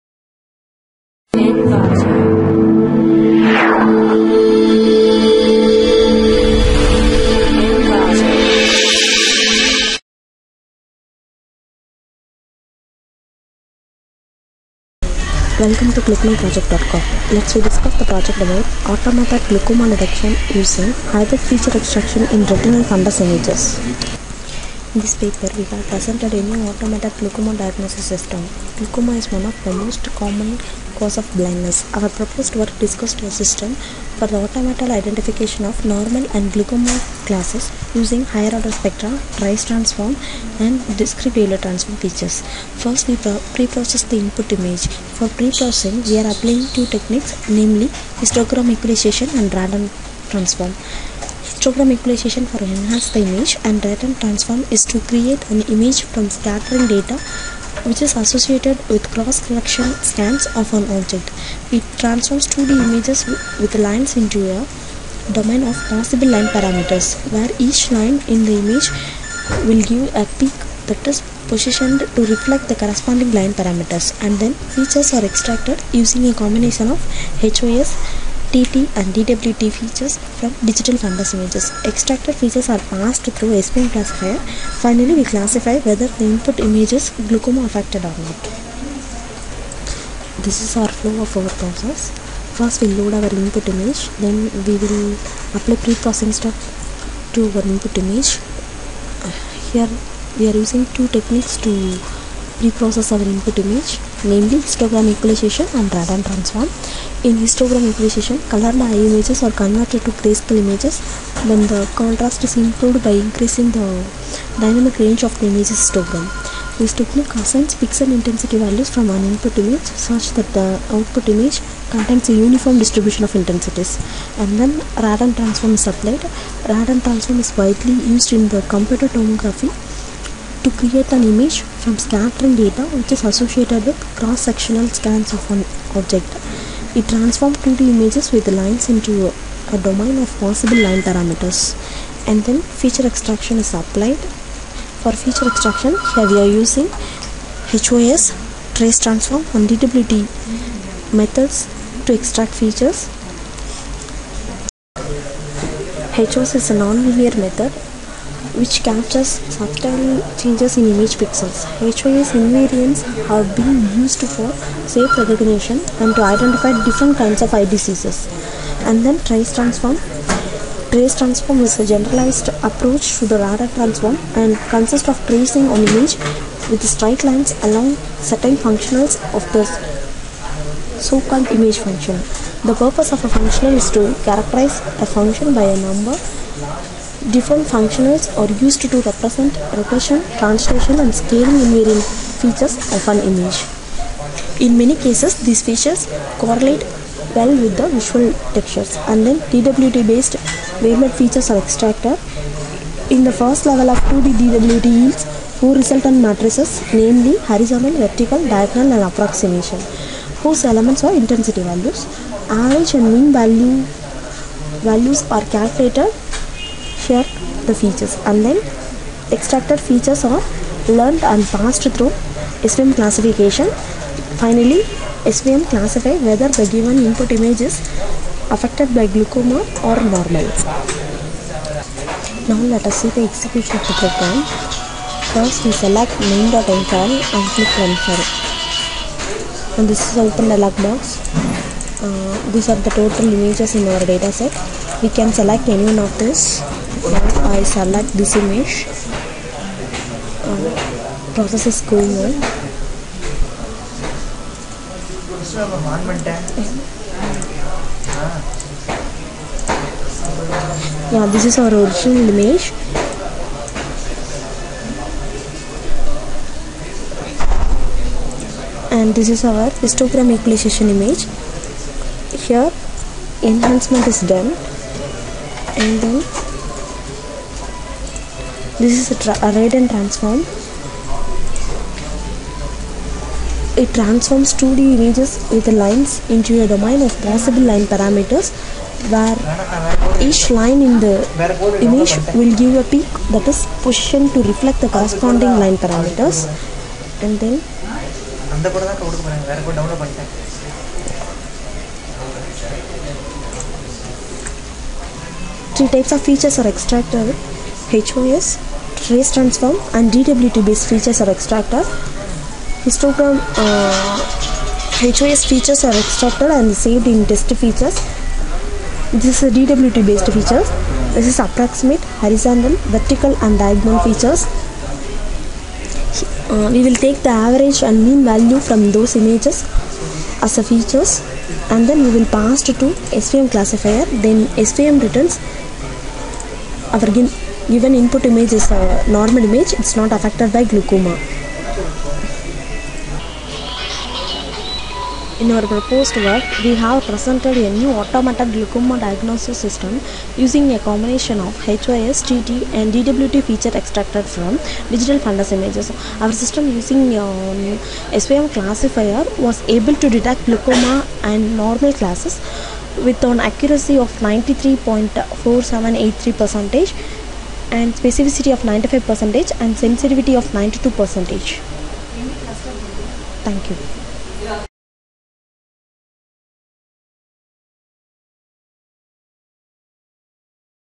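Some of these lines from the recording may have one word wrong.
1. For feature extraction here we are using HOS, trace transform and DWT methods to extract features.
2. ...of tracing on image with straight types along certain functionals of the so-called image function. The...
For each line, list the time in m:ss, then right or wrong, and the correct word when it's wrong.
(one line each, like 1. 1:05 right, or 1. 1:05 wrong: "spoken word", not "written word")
1. 2:25 right
2. 2:55 wrong: "lines", not "types".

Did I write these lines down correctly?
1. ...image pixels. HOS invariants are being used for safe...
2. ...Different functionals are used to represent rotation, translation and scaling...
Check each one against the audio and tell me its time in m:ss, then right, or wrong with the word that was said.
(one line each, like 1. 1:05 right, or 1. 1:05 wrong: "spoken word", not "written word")
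1. 2:40 right
2. 3:07 right.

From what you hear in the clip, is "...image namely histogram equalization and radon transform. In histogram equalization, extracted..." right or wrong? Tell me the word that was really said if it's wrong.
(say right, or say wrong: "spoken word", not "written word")
wrong: "colored", not "extracted".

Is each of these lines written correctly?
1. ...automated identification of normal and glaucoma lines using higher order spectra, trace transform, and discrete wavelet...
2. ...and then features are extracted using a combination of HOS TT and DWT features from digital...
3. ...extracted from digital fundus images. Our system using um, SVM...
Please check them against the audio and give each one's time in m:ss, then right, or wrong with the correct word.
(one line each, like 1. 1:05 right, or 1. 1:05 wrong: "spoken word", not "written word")
1. 0:34 wrong: "classes", not "lines"
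2. 1:14 right
3. 5:53 right.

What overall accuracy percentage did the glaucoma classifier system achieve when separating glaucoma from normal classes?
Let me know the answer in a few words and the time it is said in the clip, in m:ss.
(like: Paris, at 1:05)
93.4783%, at 6:04.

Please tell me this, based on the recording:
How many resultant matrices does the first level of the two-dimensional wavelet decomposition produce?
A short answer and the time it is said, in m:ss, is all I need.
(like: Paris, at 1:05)
4, at 3:25.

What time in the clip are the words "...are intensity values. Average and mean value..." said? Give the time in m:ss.
3:31.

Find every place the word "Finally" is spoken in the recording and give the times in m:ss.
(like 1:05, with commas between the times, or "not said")
1:24, 3:44.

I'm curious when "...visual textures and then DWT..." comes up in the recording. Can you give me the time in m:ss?
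3:17.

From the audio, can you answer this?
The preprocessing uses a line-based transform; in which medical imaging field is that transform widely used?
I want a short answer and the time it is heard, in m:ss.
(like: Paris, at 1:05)
computer tomography, at 2:08.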